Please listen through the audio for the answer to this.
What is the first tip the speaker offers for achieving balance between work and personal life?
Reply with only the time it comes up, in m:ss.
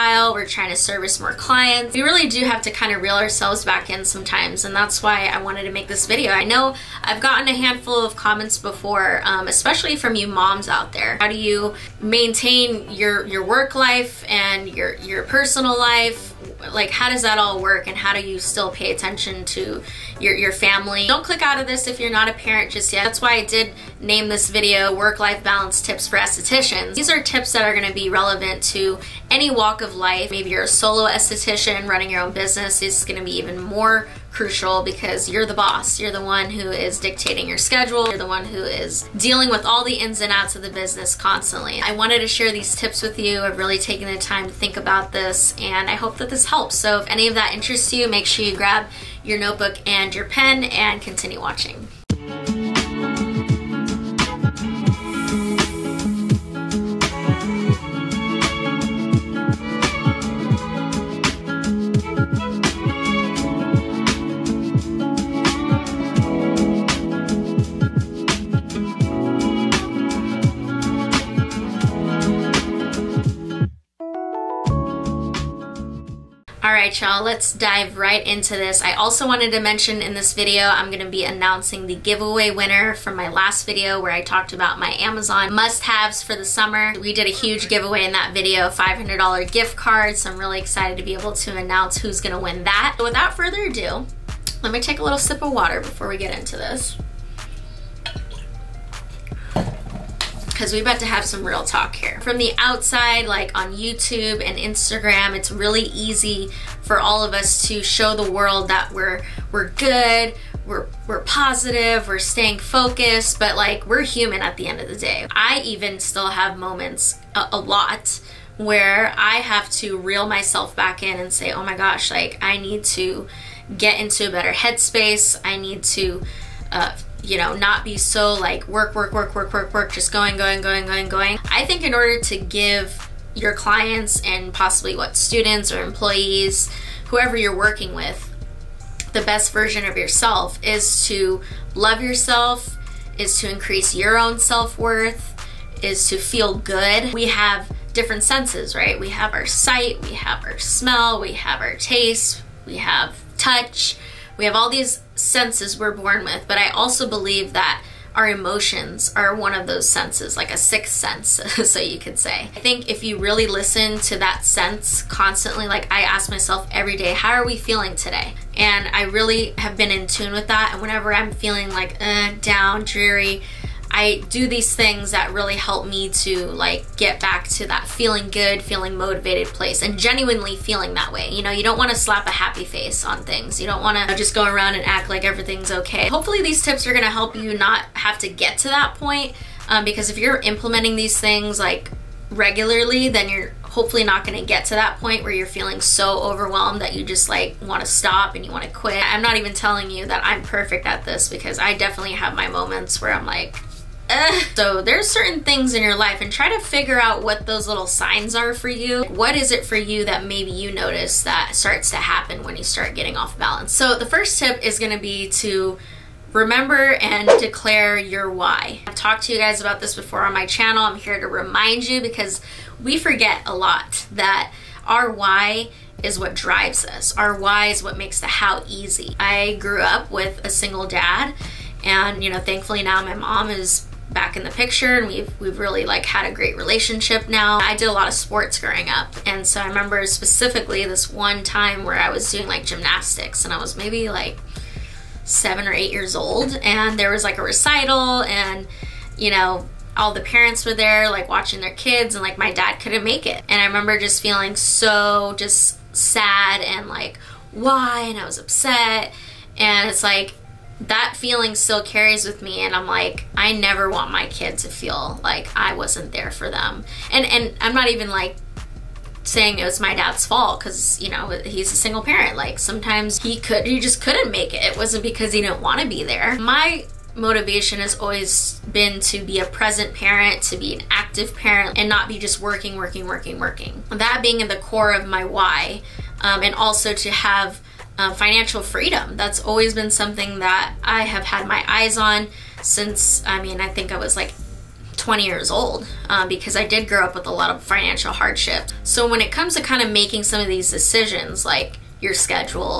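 3:37.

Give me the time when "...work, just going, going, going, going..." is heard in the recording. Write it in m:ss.
2:09.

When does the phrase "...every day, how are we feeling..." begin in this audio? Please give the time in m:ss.
2:46.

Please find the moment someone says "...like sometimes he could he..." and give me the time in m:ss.
4:32.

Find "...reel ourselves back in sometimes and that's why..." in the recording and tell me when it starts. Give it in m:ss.
0:03.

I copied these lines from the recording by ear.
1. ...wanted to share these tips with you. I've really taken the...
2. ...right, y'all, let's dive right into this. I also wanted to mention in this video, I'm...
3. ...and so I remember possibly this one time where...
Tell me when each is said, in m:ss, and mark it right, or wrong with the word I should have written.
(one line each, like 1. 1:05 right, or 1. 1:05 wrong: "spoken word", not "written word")
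1. 0:41 right
2. 1:16 right
3. 3:59 wrong: "specifically", not "possibly".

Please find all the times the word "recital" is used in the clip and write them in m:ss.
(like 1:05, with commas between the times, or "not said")
4:07.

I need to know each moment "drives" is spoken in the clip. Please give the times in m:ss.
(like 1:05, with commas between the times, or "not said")
3:46.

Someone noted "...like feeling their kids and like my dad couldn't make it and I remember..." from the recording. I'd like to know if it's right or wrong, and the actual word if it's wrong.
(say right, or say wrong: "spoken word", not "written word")
wrong: "watching", not "feeling".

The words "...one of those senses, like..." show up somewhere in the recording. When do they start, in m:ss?
2:39.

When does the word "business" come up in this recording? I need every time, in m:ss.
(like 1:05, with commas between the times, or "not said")
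0:32, 0:40.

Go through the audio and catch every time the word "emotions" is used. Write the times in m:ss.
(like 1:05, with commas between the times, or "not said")
2:38.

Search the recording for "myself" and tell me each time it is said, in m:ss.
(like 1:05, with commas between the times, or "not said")
2:00, 2:46.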